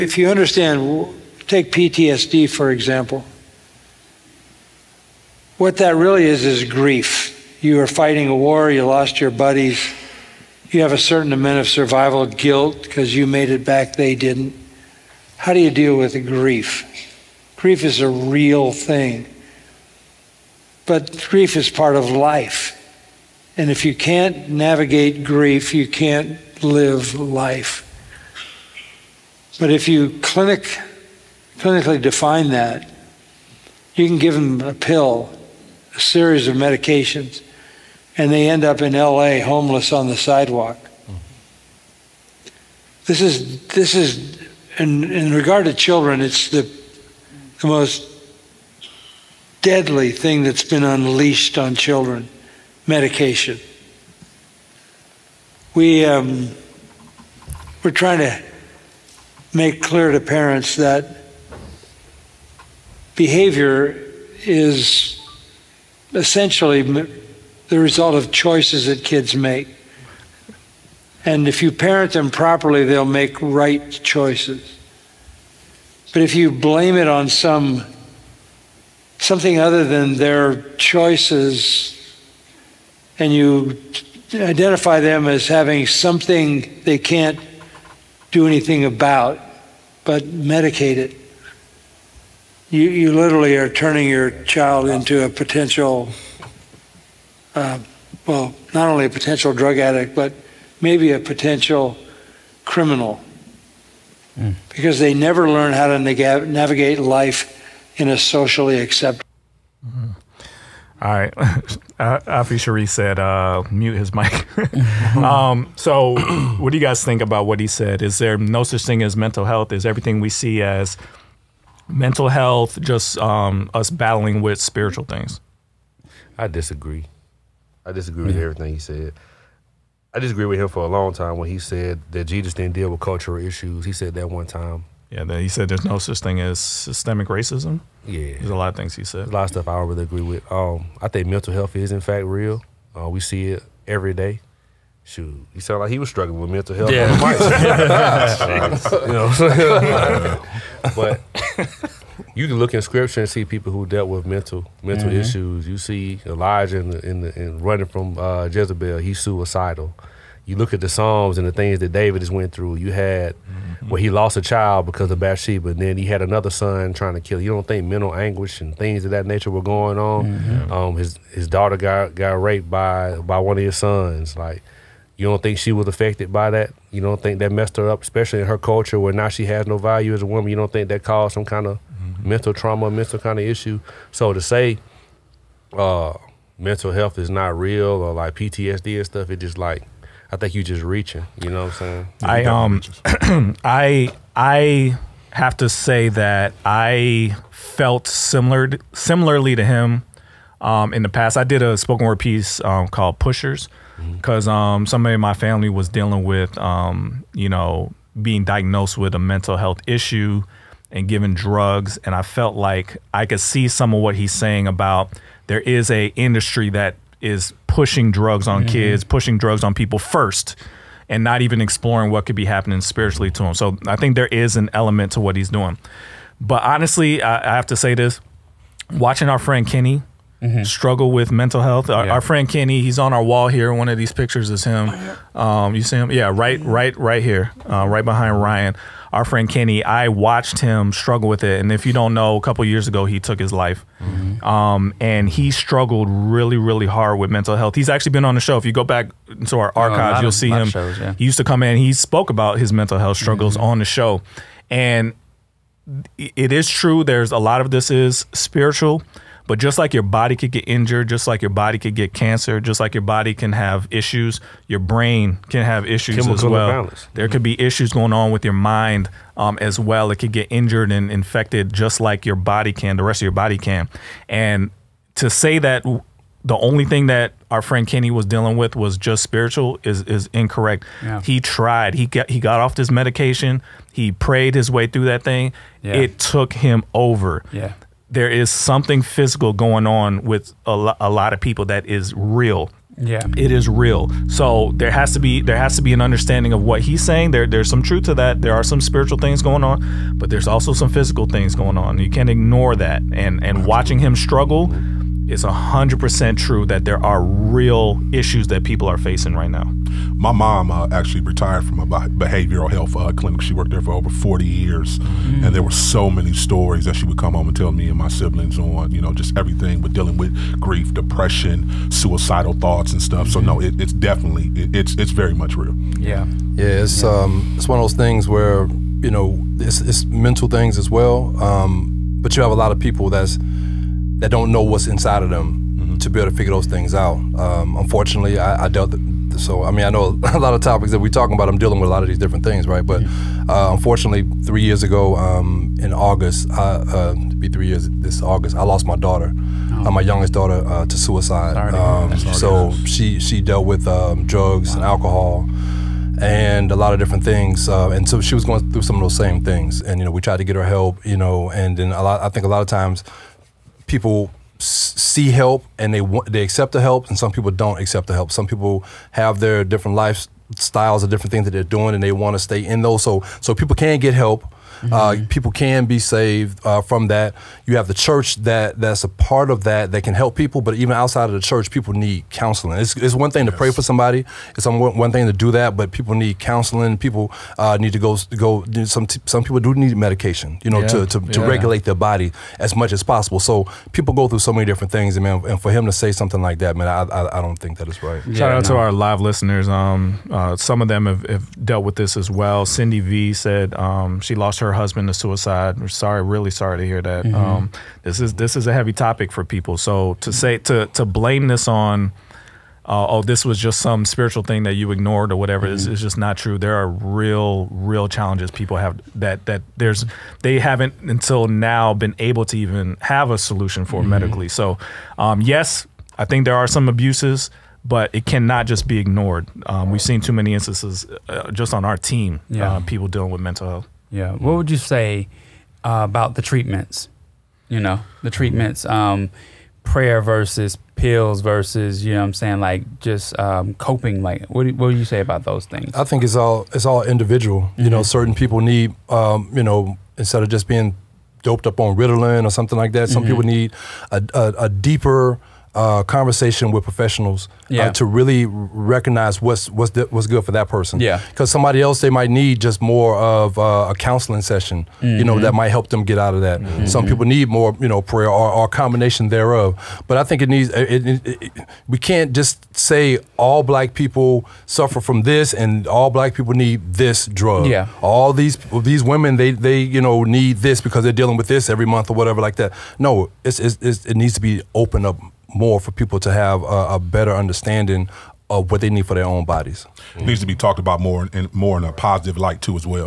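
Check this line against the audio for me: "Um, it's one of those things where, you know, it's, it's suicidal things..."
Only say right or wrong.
wrong.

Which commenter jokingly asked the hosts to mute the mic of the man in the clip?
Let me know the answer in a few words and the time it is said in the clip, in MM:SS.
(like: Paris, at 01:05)
Afi Sharif, at 01:51.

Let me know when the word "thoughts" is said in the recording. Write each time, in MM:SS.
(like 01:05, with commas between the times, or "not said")
05:22.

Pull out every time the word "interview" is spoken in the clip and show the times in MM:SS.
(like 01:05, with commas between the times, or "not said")
not said.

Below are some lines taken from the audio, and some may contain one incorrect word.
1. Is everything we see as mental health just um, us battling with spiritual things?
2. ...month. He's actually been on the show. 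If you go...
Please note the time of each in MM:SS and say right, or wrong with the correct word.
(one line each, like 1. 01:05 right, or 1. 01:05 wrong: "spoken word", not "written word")
1. 01:59 right
2. 04:07 wrong: "health", not "month".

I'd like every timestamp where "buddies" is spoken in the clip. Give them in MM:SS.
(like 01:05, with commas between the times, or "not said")
00:09.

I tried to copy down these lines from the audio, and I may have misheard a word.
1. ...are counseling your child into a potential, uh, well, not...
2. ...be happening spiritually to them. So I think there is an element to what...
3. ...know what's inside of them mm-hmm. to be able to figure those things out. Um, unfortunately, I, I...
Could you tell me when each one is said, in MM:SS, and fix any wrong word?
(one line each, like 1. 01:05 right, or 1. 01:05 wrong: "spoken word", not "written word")
1. 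01:33 wrong: "turning", not "counseling"
2. 03:42 right
3. 05:34 right.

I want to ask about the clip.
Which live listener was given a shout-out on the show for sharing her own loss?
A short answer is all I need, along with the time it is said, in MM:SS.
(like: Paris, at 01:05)
Cindy V, at 06:42.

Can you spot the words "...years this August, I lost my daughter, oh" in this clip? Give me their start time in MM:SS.
05:47.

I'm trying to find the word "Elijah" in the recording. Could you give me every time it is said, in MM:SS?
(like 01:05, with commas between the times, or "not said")
02:36.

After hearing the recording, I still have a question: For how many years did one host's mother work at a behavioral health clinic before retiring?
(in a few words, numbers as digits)
Over 40.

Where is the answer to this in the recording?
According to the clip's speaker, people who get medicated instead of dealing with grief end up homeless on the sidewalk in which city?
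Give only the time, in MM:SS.
00:38.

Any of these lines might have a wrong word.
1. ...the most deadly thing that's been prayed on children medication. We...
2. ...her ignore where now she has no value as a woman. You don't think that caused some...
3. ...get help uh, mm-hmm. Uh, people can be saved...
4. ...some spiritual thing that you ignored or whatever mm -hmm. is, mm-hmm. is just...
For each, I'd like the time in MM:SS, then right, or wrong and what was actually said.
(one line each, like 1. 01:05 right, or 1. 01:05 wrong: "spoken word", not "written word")
1. 00:47 wrong: "unleashed", not "prayed"
2. 02:58 wrong: "culture", not "ignore"
3. 06:13 right
4. 06:53 right.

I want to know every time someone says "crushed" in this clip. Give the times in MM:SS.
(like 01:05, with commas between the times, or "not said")
not said.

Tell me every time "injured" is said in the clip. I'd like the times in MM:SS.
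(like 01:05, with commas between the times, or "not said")
04:20, 04:30.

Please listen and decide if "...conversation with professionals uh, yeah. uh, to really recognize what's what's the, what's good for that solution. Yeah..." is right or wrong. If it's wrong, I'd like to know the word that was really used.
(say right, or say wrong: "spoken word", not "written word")
wrong: "person", not "solution".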